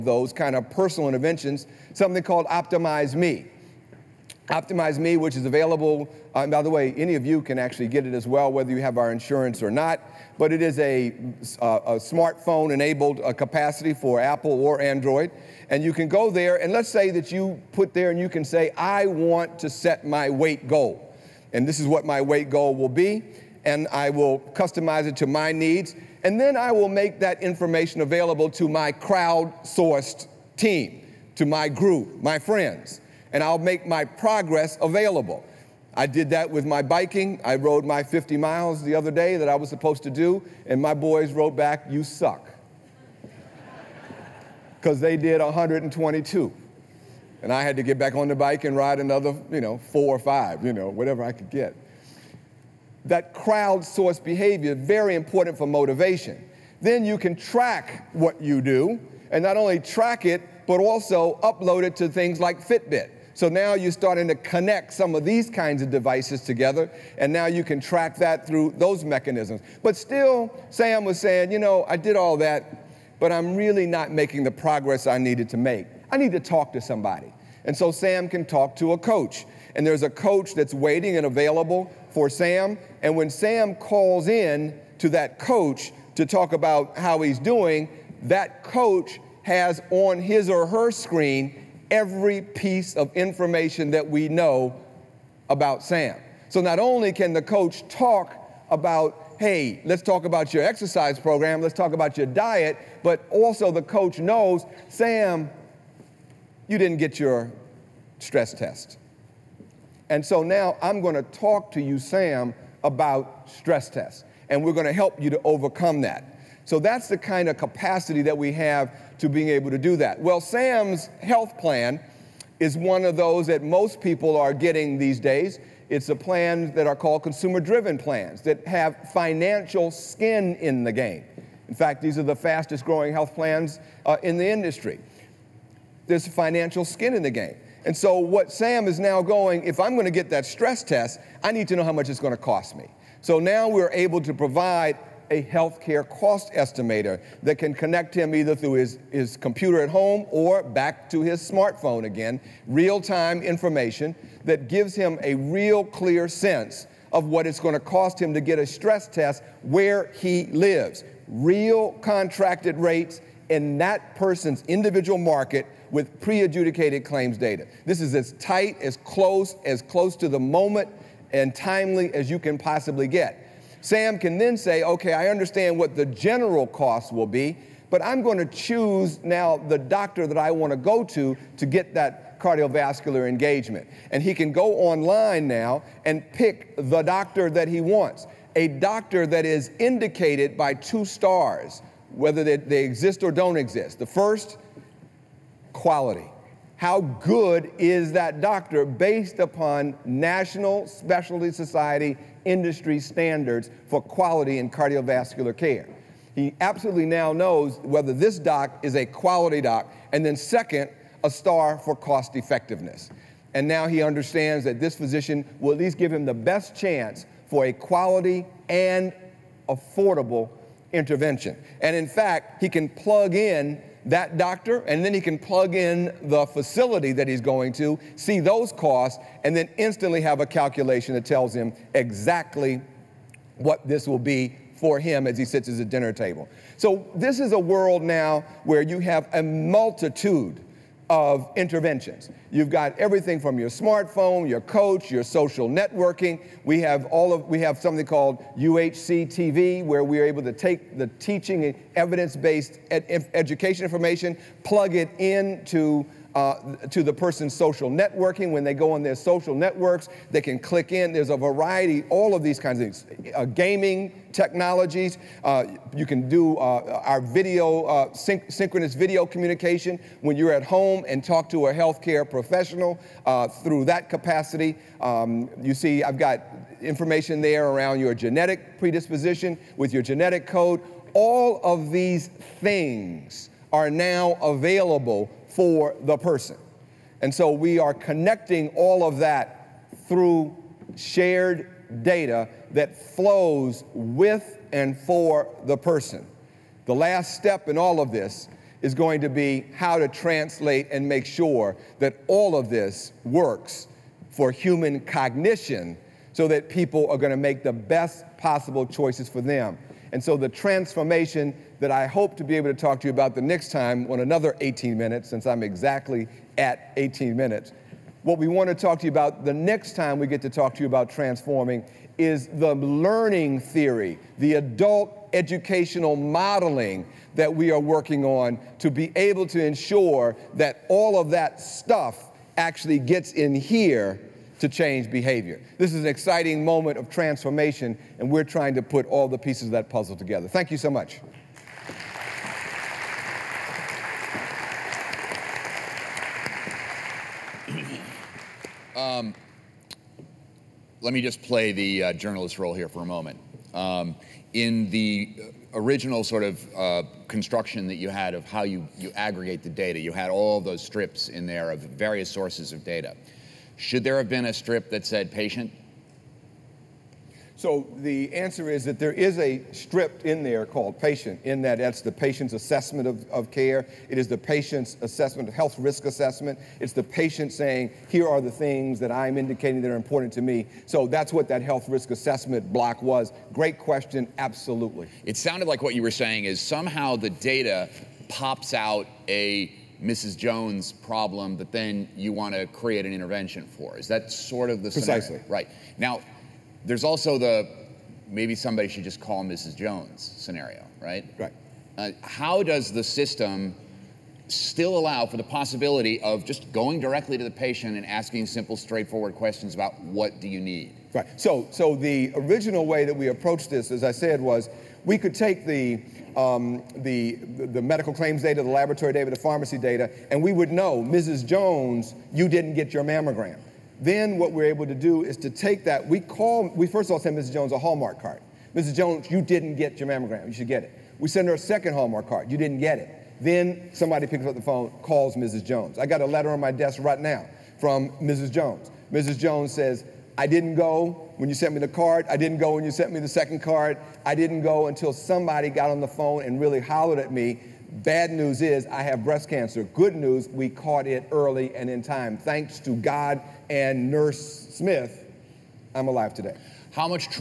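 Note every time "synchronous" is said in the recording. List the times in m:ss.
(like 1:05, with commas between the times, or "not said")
4:28.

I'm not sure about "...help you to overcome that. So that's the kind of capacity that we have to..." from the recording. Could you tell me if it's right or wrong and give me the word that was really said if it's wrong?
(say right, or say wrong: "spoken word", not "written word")
right.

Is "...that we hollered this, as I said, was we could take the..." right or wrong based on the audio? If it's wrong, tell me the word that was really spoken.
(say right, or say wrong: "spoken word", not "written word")
wrong: "approached", not "hollered".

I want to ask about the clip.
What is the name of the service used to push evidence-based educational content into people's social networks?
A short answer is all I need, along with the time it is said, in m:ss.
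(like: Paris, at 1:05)
UHC TV, at 4:08.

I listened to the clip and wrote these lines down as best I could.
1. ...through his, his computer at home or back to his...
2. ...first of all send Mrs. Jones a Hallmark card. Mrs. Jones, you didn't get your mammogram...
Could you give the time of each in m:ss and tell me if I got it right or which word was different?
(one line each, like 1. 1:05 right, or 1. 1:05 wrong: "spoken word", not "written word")
1. 2:28 right
2. 7:06 right.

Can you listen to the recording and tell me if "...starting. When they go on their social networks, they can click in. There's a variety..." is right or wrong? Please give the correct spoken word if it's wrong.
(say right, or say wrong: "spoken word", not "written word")
wrong: "networking", not "starting".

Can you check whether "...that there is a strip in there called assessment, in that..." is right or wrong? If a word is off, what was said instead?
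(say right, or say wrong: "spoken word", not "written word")
wrong: "patient", not "assessment".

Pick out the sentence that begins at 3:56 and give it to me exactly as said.
So this is a world now where you have a multitude of interventions.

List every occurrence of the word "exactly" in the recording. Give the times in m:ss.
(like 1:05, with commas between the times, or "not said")
3:51, 5:15.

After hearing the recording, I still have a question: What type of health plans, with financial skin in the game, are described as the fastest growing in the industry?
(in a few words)
consumer driven plans.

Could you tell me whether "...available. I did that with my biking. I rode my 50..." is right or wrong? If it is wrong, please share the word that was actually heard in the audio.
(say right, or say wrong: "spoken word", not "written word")
right.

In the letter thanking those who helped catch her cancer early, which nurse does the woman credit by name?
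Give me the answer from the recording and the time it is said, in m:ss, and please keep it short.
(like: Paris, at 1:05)
Nurse Smith, at 7:34.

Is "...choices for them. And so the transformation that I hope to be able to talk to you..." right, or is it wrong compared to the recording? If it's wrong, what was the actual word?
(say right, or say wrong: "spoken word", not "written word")
right.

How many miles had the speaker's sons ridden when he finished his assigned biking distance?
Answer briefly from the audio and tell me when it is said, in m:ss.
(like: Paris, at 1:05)
122, at 0:45.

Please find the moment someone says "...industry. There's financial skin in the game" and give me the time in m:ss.
2:14.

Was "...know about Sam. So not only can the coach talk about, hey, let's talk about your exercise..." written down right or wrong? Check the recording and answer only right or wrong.
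right.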